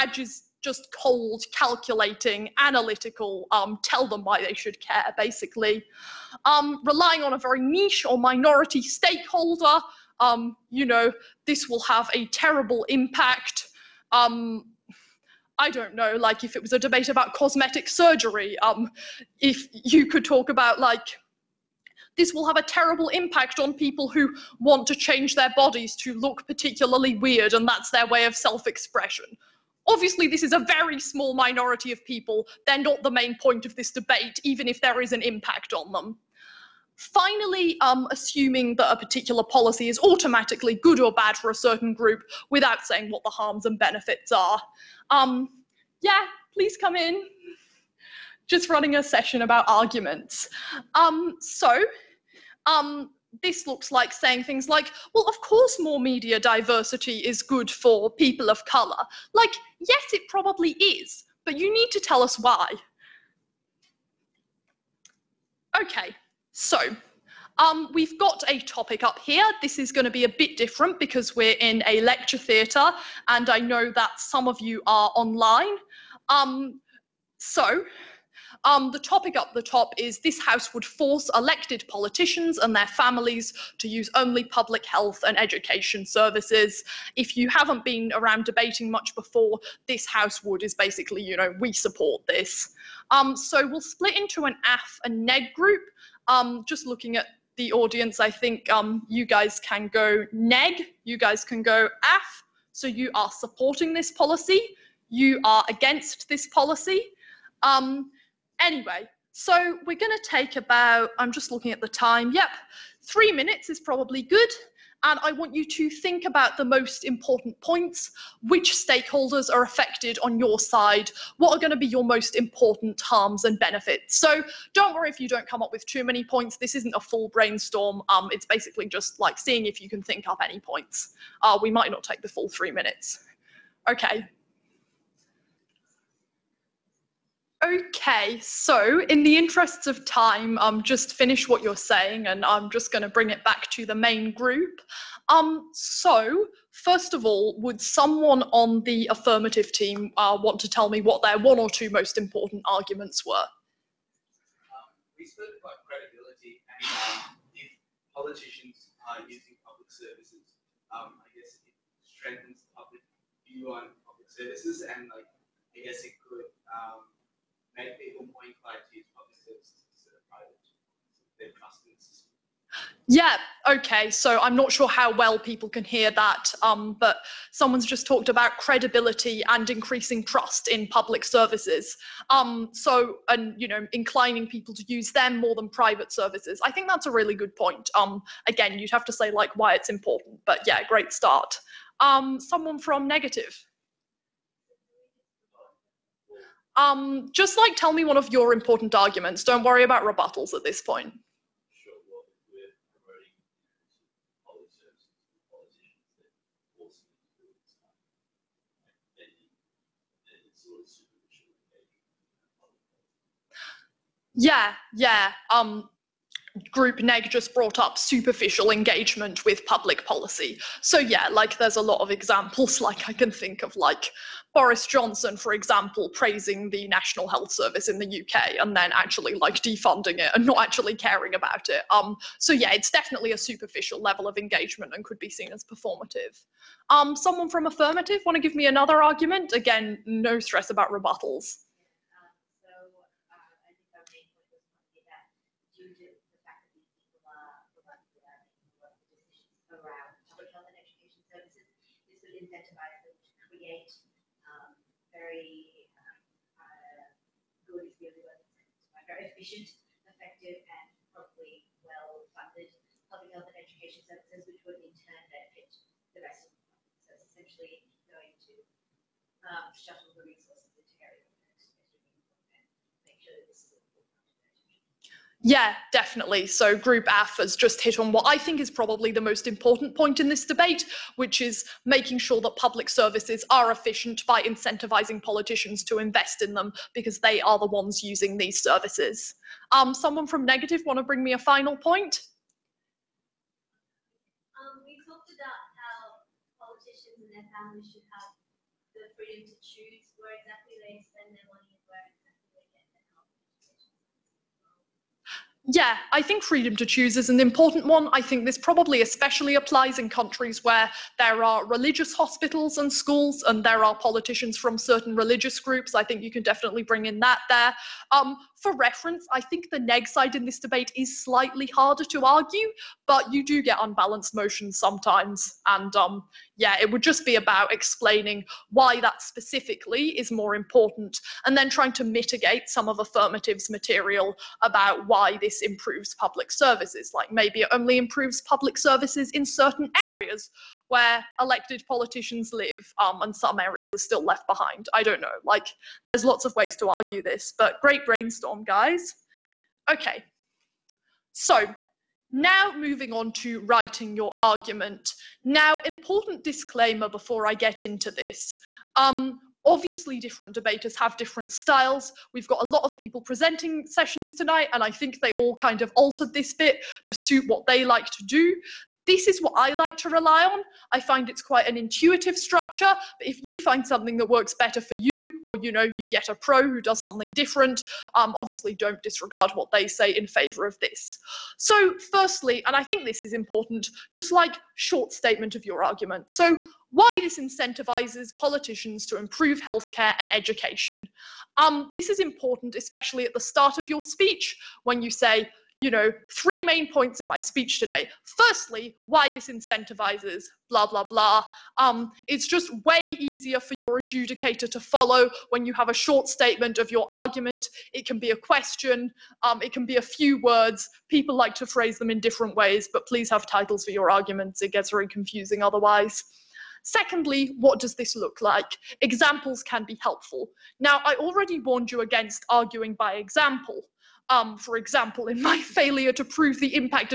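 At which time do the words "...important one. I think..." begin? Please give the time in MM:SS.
05:07.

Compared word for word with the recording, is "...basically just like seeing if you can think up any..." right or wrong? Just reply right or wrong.
right.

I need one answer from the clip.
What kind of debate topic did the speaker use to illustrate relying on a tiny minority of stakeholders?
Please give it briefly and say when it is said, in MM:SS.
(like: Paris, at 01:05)
cosmetic surgery, at 00:17.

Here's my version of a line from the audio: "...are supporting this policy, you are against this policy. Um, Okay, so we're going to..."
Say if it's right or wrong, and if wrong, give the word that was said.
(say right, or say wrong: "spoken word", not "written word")
wrong: "Anyway", not "Okay".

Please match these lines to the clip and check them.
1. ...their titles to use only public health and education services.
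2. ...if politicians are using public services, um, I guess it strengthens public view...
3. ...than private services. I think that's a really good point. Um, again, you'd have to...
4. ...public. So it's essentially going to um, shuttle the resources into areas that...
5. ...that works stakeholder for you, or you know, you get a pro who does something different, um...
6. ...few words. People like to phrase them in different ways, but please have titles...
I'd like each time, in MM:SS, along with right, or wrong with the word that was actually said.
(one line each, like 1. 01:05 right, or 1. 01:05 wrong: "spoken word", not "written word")
1. 01:22 wrong: "families", not "titles"
2. 02:37 right
3. 03:05 right
4. 04:26 right
5. 06:14 wrong: "better", not "stakeholder"
6. 06:50 right.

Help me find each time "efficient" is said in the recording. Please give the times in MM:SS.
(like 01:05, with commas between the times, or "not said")
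04:19, 04:43.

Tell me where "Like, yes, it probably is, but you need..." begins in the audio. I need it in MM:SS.
00:59.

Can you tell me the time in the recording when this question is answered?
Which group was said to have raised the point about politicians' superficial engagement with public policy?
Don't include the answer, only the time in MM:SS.
03:36.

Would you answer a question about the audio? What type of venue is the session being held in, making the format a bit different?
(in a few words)
a lecture theatre.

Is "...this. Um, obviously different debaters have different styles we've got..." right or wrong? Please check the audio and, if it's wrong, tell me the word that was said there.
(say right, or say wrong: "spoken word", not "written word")
right.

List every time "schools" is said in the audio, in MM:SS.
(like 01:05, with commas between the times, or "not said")
05:12.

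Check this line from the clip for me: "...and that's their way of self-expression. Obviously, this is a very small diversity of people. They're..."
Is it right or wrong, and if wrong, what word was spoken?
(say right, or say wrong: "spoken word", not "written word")
wrong: "minority", not "diversity".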